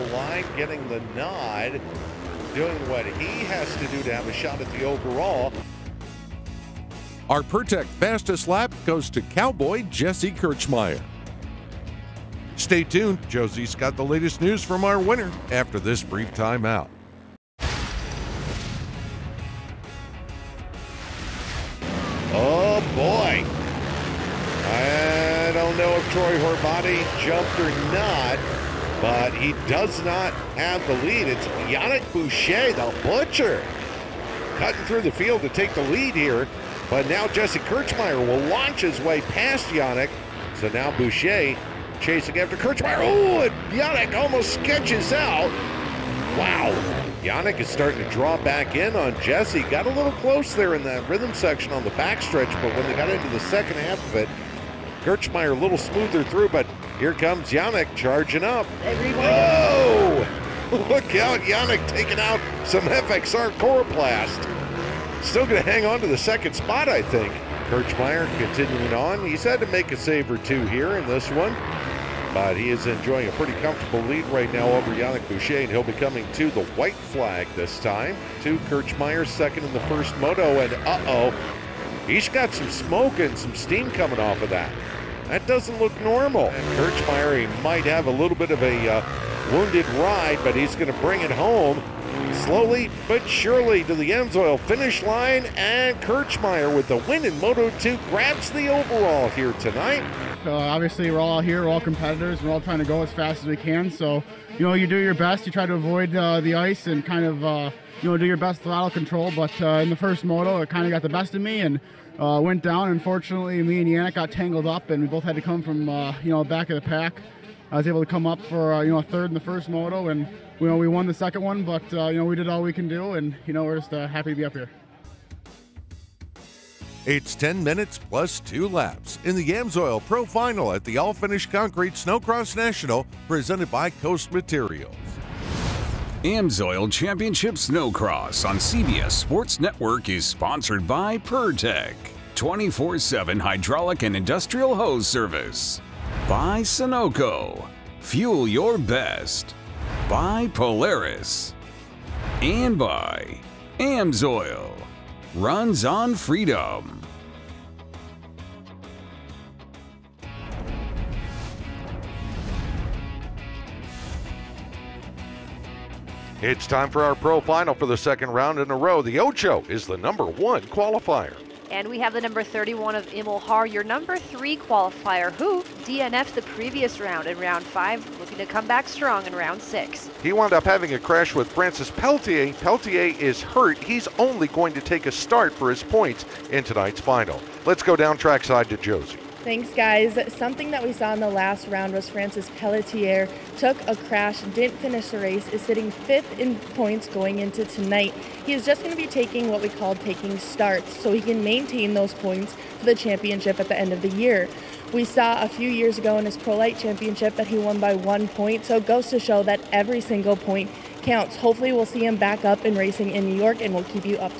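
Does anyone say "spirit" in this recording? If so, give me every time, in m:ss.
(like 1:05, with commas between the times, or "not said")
not said.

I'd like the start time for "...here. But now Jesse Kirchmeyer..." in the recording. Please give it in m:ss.
0:36.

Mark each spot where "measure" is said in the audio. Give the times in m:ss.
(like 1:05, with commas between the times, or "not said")
not said.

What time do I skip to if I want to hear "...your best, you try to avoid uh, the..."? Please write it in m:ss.
1:44.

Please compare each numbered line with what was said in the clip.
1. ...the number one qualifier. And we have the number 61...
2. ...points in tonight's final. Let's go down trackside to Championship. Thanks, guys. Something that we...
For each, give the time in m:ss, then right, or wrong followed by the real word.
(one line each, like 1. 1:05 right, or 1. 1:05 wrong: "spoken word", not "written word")
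1. 2:49 wrong: "31", not "61"
2. 3:05 wrong: "Josie", not "Championship".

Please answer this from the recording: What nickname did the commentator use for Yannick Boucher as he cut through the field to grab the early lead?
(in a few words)
the butcher.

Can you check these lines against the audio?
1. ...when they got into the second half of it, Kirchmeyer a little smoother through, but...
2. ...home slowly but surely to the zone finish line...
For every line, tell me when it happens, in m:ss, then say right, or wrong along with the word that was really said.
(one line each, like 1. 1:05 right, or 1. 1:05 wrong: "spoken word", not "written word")
1. 0:52 right
2. 1:31 right.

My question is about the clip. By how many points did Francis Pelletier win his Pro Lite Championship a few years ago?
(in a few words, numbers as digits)
1 point.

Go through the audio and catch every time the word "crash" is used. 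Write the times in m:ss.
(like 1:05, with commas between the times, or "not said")
3:00, 3:13.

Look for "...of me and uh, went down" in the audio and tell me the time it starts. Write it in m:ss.
1:51.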